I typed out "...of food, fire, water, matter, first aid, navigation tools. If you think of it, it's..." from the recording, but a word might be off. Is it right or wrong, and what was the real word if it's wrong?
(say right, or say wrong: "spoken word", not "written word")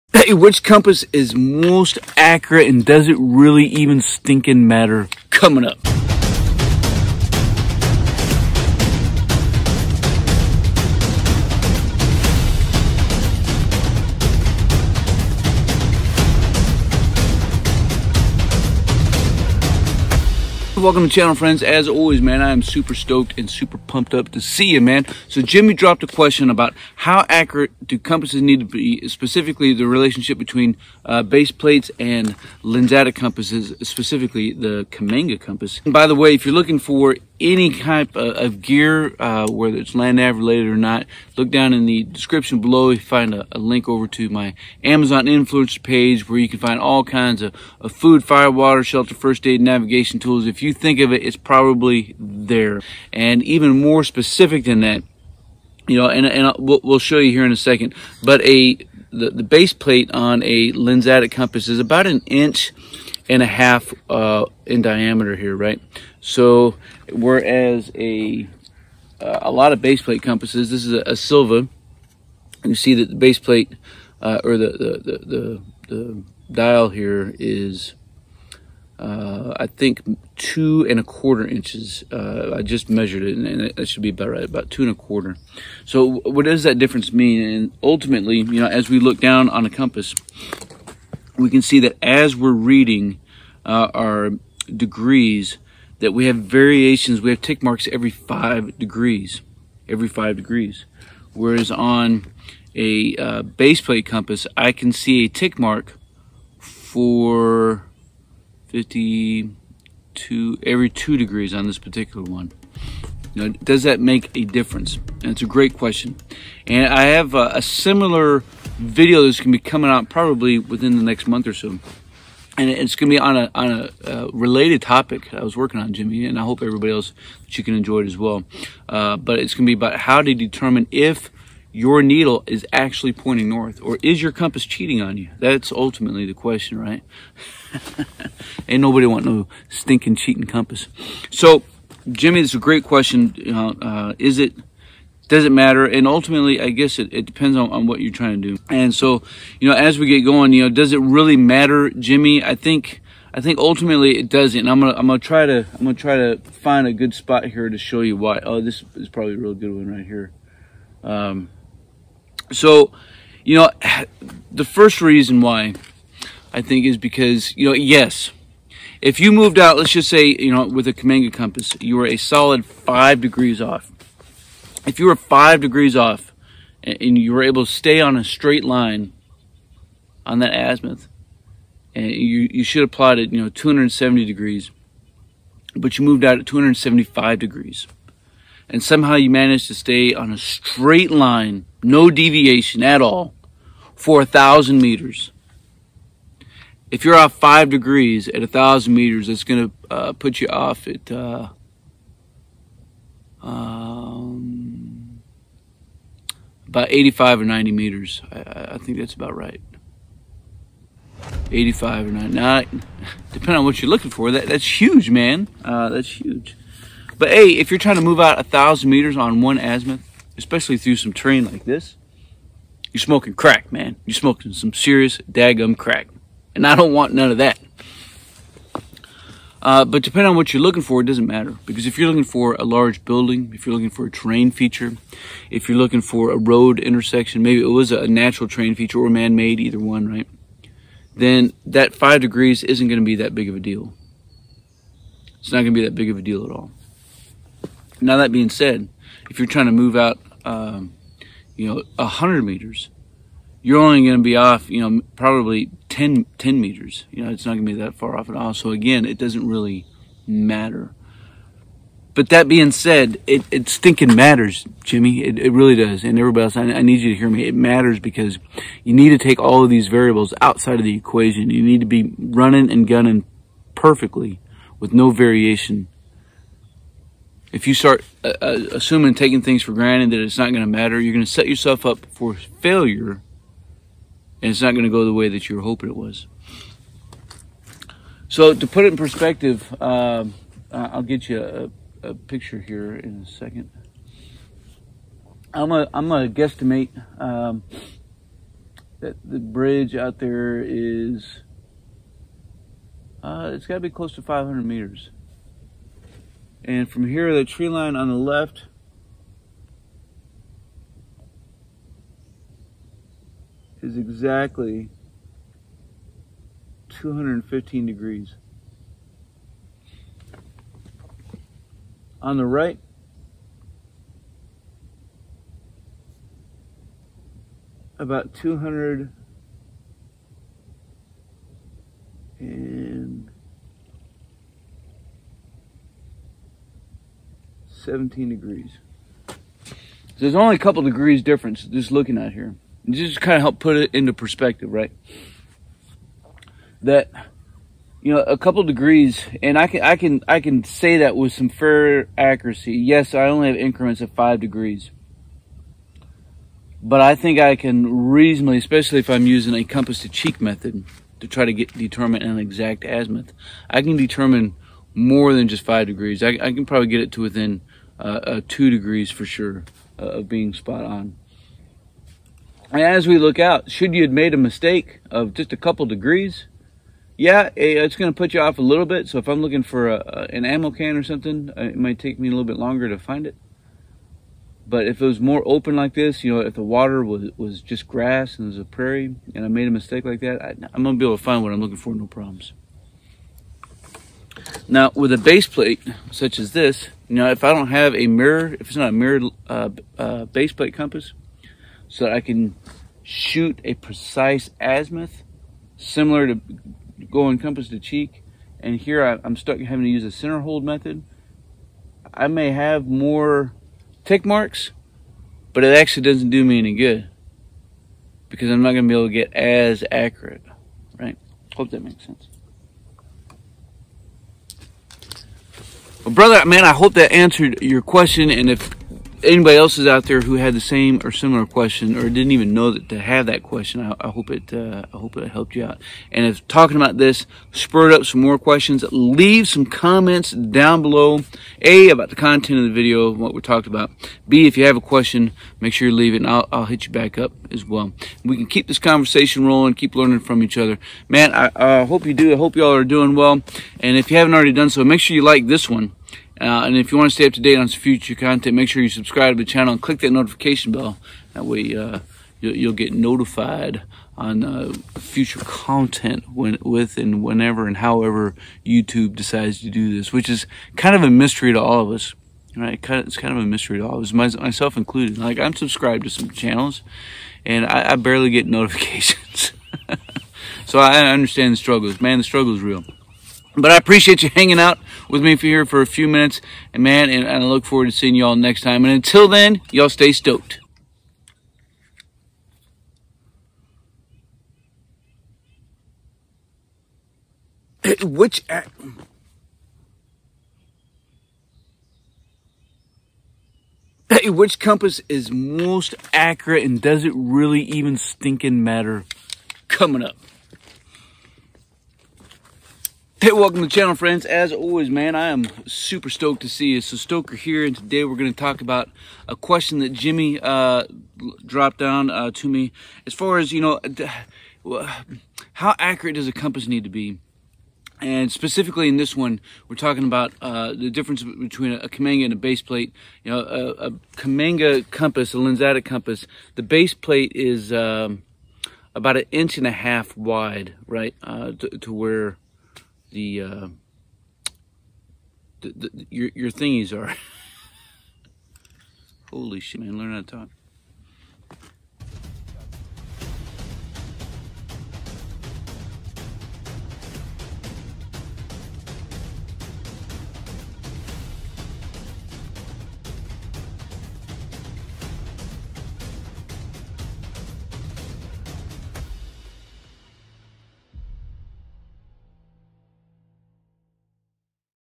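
wrong: "shelter", not "matter".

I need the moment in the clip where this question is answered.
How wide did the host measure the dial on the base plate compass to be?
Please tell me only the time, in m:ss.
1:20.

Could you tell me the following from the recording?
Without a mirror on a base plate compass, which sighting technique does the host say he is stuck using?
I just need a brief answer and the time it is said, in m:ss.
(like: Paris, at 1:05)
center hold method, at 6:50.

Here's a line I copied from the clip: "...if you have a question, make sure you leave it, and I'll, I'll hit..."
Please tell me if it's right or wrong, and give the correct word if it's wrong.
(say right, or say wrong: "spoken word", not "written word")
right.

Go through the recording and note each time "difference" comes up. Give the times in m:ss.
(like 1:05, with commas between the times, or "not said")
1:26, 1:54, 5:41, 8:50.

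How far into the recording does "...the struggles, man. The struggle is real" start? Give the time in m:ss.
8:01.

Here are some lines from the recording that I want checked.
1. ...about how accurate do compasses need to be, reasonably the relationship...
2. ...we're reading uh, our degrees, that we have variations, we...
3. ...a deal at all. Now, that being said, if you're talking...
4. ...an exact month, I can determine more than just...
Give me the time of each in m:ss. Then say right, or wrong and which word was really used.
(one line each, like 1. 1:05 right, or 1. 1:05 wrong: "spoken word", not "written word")
1. 0:26 wrong: "specifically", not "reasonably"
2. 1:32 right
3. 4:06 wrong: "trying", not "talking"
4. 6:02 wrong: "azimuth", not "month".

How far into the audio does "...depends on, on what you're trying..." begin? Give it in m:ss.
2:27.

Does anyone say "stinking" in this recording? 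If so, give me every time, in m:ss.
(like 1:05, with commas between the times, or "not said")
0:04, 2:19, 4:23, 8:27.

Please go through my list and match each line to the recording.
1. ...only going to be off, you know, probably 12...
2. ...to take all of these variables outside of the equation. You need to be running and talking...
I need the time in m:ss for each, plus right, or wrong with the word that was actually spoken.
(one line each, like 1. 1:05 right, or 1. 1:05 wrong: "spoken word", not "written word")
1. 4:13 wrong: "10", not "12"
2. 4:29 wrong: "gunning", not "talking".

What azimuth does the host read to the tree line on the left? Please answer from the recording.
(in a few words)
215 degrees.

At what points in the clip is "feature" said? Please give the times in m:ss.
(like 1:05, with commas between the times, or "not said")
3:54, 3:58.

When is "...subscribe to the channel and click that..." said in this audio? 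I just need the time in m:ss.
7:38.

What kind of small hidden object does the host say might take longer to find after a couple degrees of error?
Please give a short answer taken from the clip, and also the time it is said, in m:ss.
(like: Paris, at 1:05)
ammo can, at 6:20.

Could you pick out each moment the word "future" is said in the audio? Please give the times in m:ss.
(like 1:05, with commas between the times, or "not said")
7:37, 7:44.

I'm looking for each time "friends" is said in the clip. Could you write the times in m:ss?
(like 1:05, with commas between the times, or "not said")
0:21, 8:33.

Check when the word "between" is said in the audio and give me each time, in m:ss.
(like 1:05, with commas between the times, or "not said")
0:30, 8:51.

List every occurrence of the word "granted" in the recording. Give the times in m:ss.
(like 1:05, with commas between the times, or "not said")
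4:39.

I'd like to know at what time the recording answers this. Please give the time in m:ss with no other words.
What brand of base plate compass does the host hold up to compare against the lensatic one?
1:10.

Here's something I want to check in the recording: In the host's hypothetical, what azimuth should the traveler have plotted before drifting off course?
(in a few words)
270 degrees.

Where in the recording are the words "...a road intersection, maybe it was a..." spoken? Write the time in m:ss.
3:56.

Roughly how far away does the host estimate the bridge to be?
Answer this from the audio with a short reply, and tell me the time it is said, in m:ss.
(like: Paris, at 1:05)
500 meters, at 5:04.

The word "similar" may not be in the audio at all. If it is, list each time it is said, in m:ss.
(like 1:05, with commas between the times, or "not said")
1:57, 6:45, 7:11.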